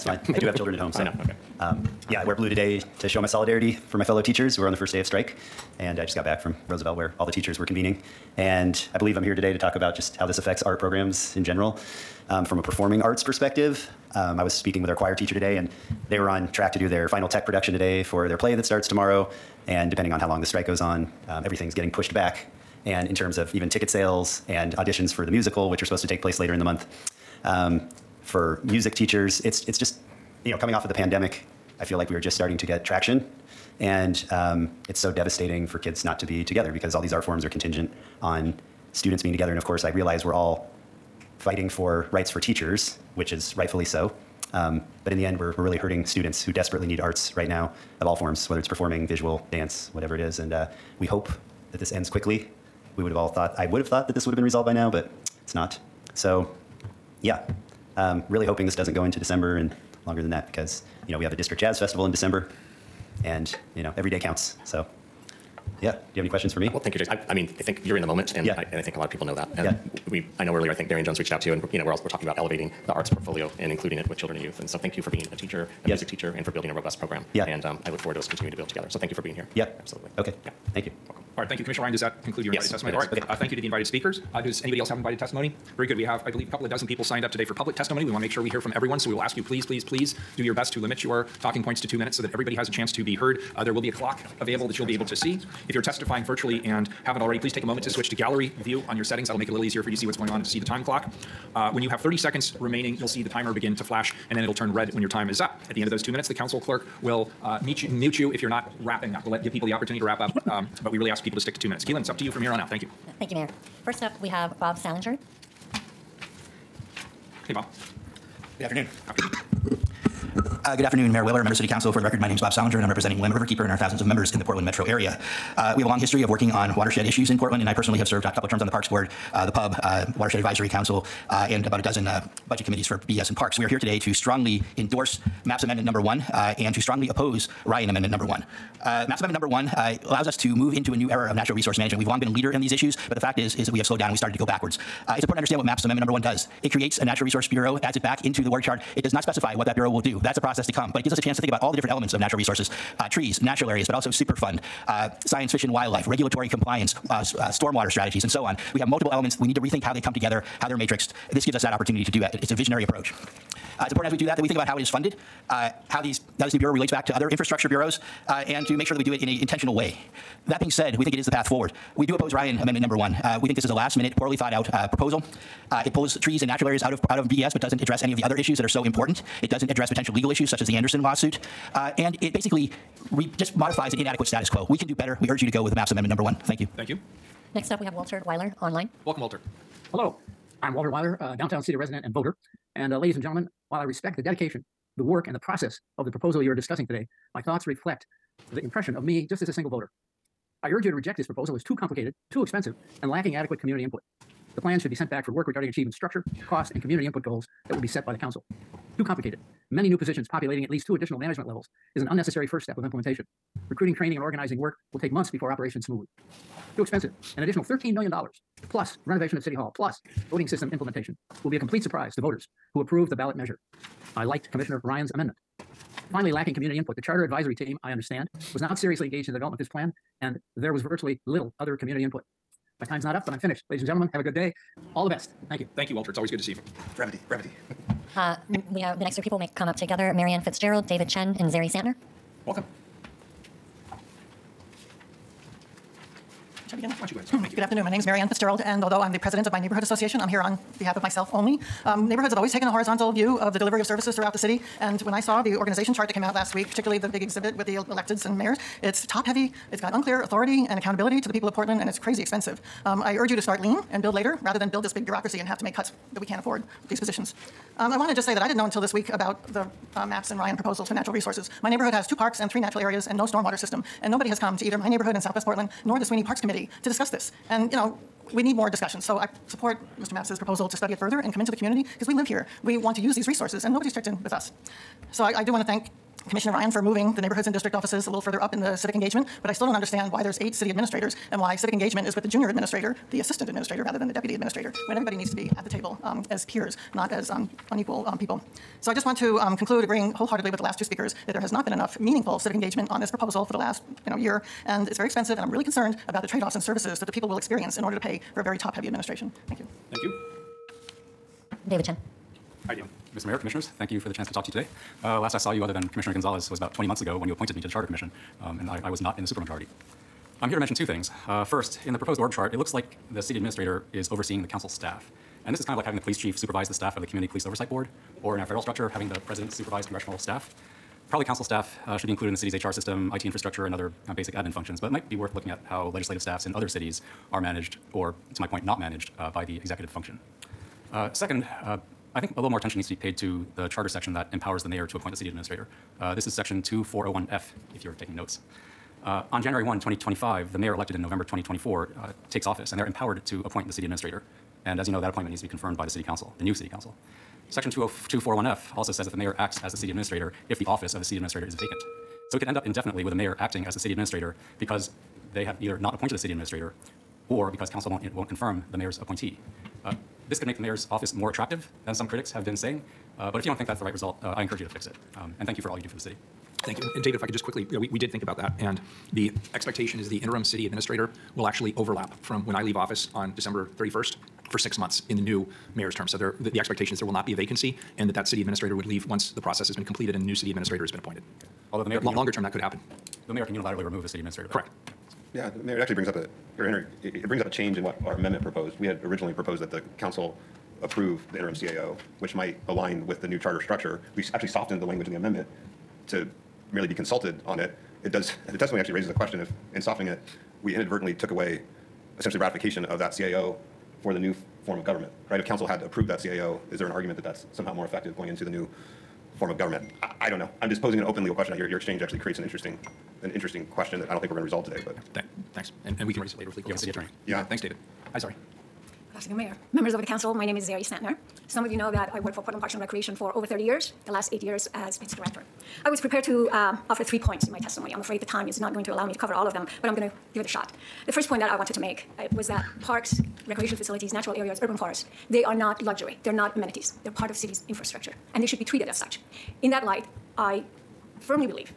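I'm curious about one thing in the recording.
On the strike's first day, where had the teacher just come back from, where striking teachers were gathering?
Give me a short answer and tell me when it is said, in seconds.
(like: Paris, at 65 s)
Roosevelt, at 6 s.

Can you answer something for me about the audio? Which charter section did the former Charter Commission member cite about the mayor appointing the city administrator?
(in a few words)
2401F.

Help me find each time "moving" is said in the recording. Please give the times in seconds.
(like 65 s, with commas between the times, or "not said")
286 s.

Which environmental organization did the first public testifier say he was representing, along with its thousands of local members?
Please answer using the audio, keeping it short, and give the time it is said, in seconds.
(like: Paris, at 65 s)
Willamette Riverkeeper, at 123 s.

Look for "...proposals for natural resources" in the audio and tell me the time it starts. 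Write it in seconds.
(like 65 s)
270 s.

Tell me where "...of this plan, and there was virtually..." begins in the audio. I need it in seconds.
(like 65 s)
229 s.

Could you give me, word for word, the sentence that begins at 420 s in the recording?
I'm just posing an open legal question.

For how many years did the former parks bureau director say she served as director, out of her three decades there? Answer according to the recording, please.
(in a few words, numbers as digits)
8.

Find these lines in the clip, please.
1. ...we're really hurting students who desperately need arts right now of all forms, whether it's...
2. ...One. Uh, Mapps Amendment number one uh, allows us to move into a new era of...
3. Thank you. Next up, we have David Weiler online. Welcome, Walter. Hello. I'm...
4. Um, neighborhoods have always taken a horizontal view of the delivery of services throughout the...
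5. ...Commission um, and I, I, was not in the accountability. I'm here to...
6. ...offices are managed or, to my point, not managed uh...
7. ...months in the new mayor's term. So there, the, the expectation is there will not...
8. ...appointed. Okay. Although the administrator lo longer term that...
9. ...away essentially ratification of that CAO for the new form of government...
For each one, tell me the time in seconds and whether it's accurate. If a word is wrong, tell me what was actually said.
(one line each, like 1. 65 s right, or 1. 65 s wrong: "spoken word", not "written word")
1. 45 s right
2. 138 s right
3. 186 s wrong: "Walter", not "David"
4. 251 s right
5. 317 s wrong: "supermajority", not "accountability"
6. 336 s wrong: "cities", not "offices"
7. 384 s right
8. 390 s wrong: "mayor", not "administrator"
9. 411 s right.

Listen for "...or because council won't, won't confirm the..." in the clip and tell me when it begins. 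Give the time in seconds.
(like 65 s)
367 s.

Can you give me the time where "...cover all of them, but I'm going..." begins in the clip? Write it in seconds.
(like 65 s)
439 s.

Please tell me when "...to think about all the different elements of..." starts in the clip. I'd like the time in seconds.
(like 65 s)
151 s.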